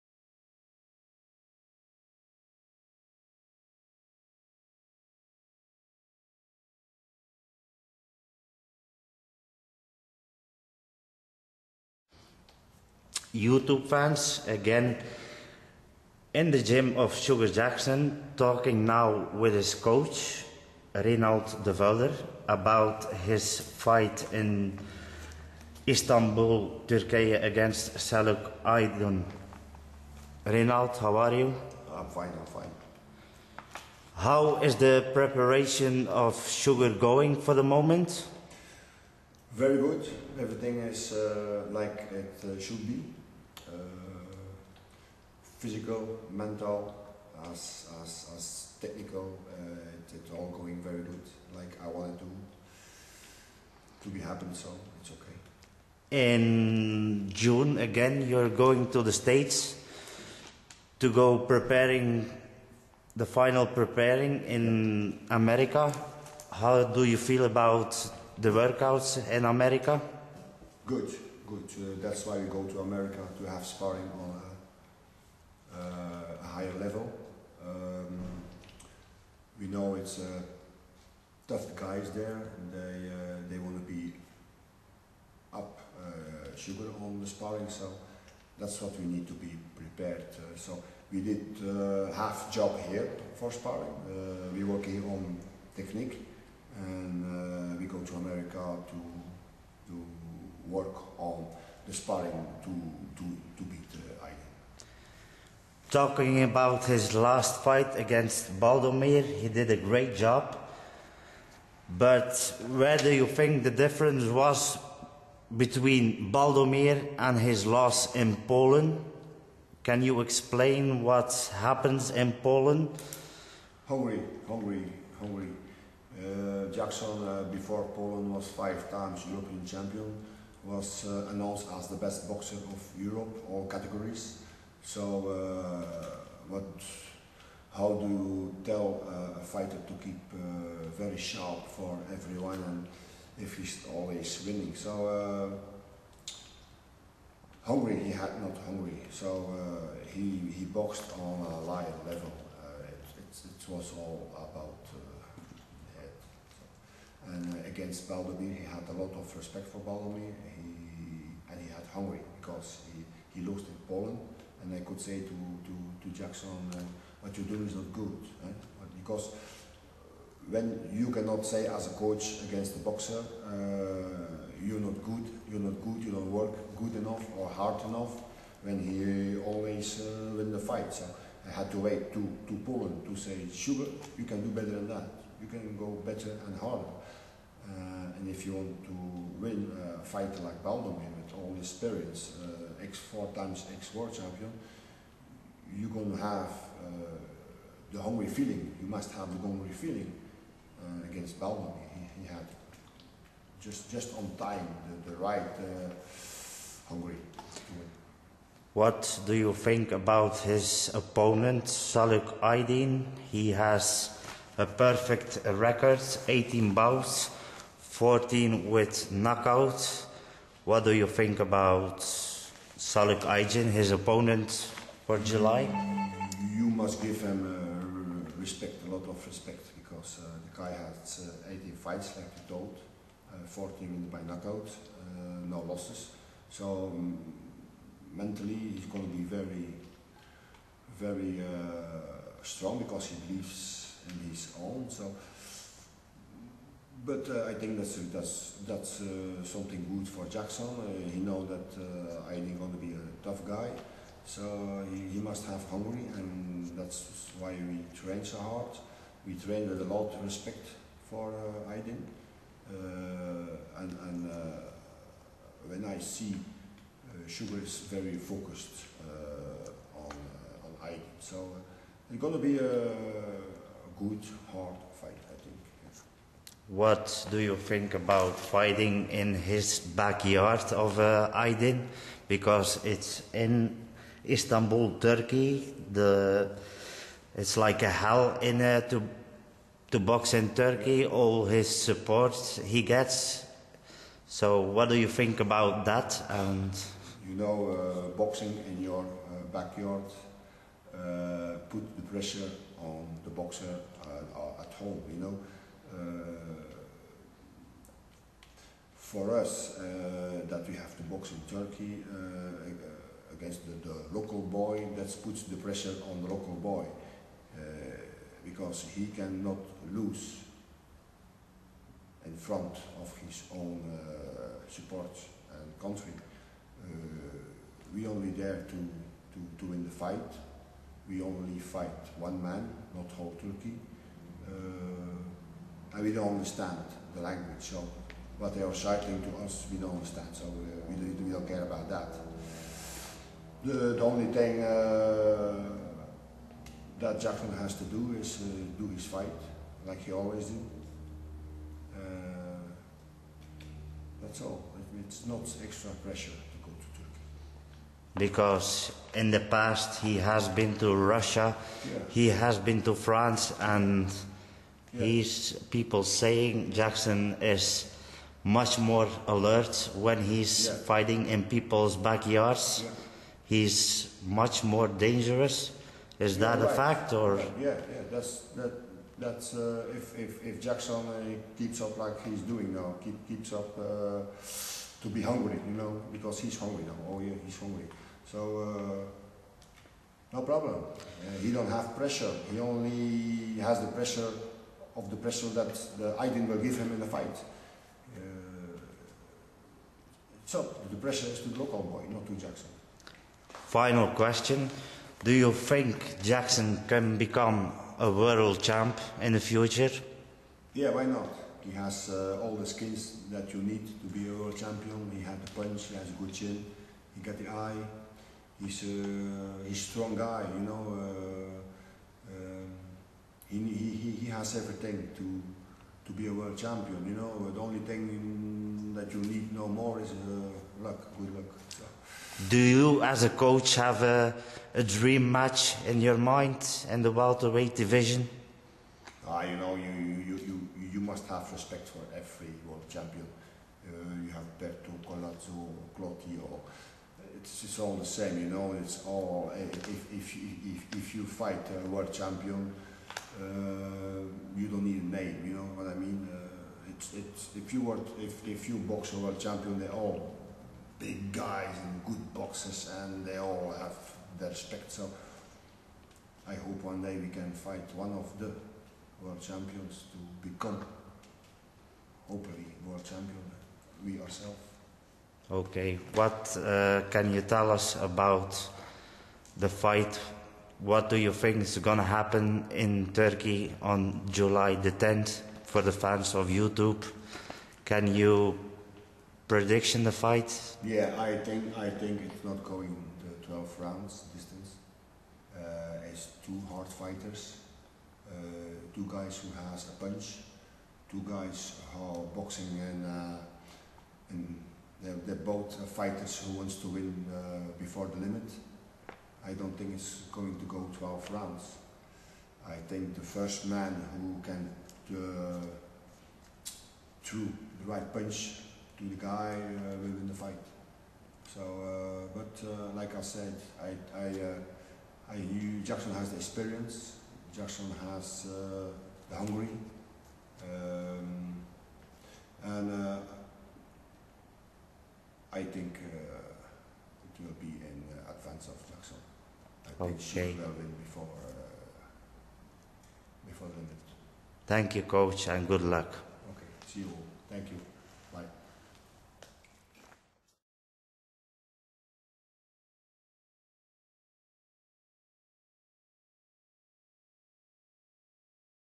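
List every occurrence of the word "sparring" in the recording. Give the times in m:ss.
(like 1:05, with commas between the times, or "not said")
1:13, 1:27, 1:33, 1:41.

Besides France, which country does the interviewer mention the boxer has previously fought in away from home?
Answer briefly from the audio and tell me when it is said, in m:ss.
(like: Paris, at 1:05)
Russia, at 6:00.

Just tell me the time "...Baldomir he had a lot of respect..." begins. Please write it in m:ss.
2:38.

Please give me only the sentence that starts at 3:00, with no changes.
So I had to wait to, to him to say, Sugar, you can do better than that.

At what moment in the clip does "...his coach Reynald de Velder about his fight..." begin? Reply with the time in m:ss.
0:19.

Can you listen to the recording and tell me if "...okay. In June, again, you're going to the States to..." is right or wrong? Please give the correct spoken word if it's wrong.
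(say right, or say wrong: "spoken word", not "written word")
right.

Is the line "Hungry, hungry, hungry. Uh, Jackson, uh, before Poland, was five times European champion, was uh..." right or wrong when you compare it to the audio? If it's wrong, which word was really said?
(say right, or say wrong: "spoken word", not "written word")
right.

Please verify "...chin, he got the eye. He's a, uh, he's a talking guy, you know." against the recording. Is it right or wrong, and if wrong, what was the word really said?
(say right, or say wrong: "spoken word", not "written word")
wrong: "strong", not "talking".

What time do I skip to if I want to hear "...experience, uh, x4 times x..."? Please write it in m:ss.
3:11.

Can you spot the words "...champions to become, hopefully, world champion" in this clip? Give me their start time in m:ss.
7:49.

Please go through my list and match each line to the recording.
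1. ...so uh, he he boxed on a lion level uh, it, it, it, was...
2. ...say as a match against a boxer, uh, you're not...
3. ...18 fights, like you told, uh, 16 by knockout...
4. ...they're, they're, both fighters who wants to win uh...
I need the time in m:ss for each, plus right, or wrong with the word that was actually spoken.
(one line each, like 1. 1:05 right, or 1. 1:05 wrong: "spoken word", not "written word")
1. 2:29 right
2. 2:51 wrong: "coach", not "match"
3. 3:51 wrong: "14", not "16"
4. 8:25 right.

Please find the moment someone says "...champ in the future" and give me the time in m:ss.
6:48.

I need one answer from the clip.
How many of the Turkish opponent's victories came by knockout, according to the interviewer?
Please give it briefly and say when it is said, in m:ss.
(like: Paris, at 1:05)
14, at 3:37.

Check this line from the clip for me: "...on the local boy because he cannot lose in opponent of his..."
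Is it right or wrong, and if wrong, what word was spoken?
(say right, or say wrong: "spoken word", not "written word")
wrong: "front", not "opponent".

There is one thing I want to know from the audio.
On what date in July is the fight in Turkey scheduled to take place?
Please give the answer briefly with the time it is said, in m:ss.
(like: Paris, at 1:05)
July 10, at 8:04.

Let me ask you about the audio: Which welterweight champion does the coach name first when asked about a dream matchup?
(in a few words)
Berto.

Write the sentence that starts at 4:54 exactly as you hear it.
So what do you think about that?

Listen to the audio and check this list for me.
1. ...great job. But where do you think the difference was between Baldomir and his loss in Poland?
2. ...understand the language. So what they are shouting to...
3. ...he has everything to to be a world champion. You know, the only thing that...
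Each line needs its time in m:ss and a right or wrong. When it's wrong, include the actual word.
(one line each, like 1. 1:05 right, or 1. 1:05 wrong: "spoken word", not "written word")
1. 1:49 right
2. 5:36 right
3. 7:04 right.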